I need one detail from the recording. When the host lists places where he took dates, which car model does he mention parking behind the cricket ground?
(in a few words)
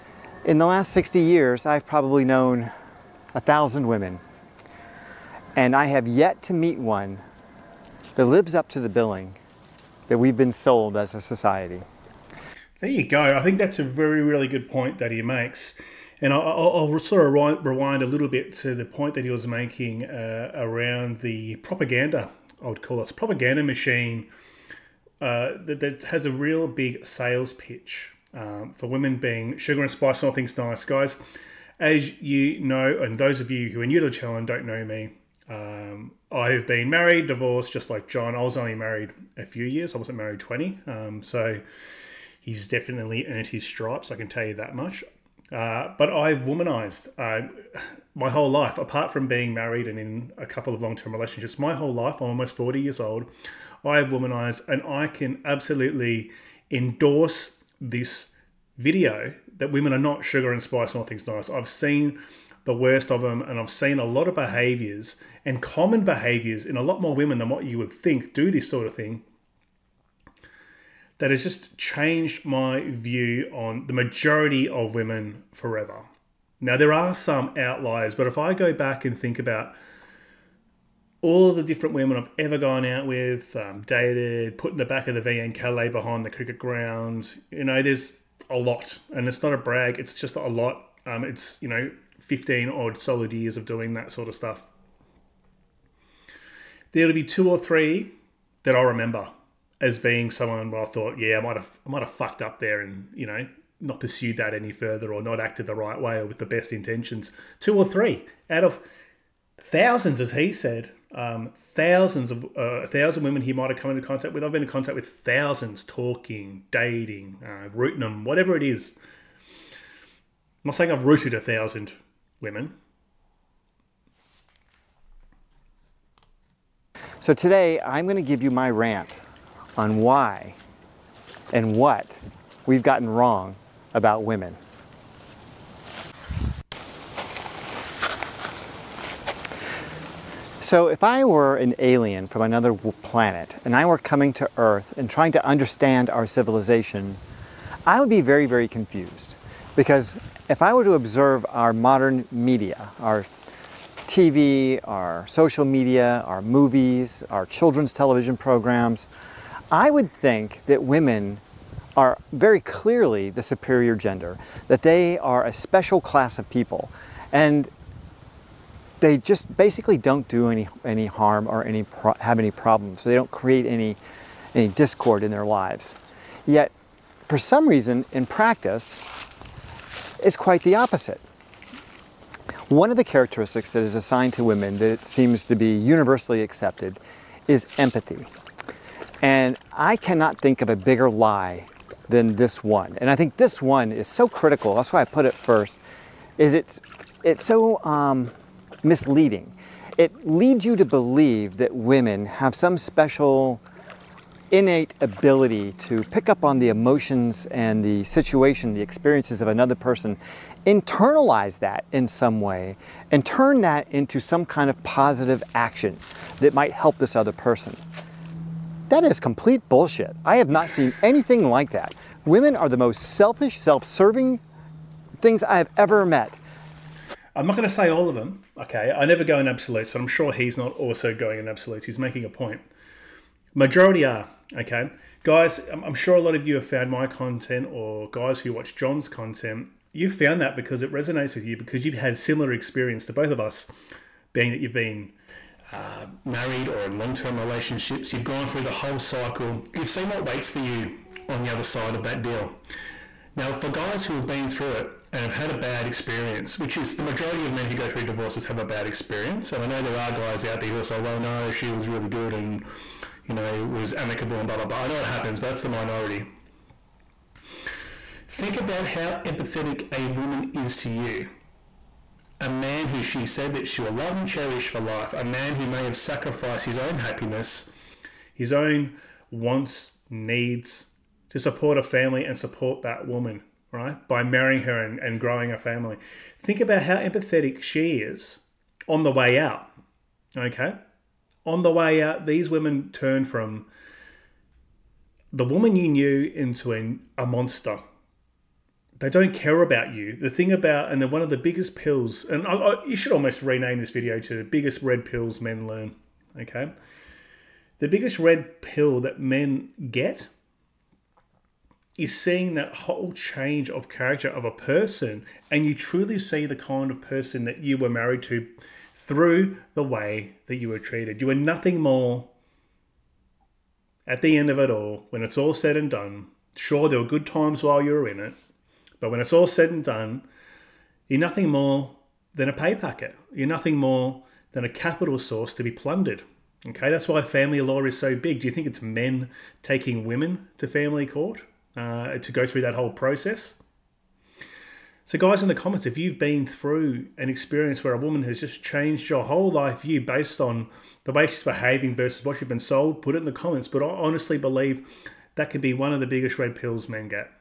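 VN Calais.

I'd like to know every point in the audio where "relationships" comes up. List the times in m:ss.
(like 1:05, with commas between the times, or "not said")
0:51, 4:07.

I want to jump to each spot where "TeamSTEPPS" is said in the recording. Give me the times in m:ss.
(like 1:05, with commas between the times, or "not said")
not said.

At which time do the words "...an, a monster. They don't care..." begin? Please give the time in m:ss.
4:56.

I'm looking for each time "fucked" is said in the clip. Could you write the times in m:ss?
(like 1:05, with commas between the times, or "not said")
1:42.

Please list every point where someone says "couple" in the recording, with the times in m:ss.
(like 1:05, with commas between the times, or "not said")
0:50.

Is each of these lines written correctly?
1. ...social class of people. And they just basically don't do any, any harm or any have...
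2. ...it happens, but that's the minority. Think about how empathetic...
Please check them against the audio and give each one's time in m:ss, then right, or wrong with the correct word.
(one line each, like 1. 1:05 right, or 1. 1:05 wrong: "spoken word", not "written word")
1. 2:45 wrong: "special", not "social"
2. 4:24 right.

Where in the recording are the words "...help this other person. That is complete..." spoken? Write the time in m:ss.
3:36.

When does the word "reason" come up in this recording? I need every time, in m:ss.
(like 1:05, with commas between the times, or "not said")
2:57.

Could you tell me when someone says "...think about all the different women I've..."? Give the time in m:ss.
1:19.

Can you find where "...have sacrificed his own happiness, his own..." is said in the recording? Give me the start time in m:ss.
4:35.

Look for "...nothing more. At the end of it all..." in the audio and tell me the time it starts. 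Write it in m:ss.
5:21.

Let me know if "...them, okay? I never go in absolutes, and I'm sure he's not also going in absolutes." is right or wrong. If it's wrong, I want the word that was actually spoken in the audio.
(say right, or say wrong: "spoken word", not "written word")
right.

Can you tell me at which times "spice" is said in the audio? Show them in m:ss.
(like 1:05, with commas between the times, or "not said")
0:29, 1:00.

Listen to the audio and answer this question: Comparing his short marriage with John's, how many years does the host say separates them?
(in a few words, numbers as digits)
20.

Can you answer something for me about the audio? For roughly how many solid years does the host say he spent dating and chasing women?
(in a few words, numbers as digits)
15.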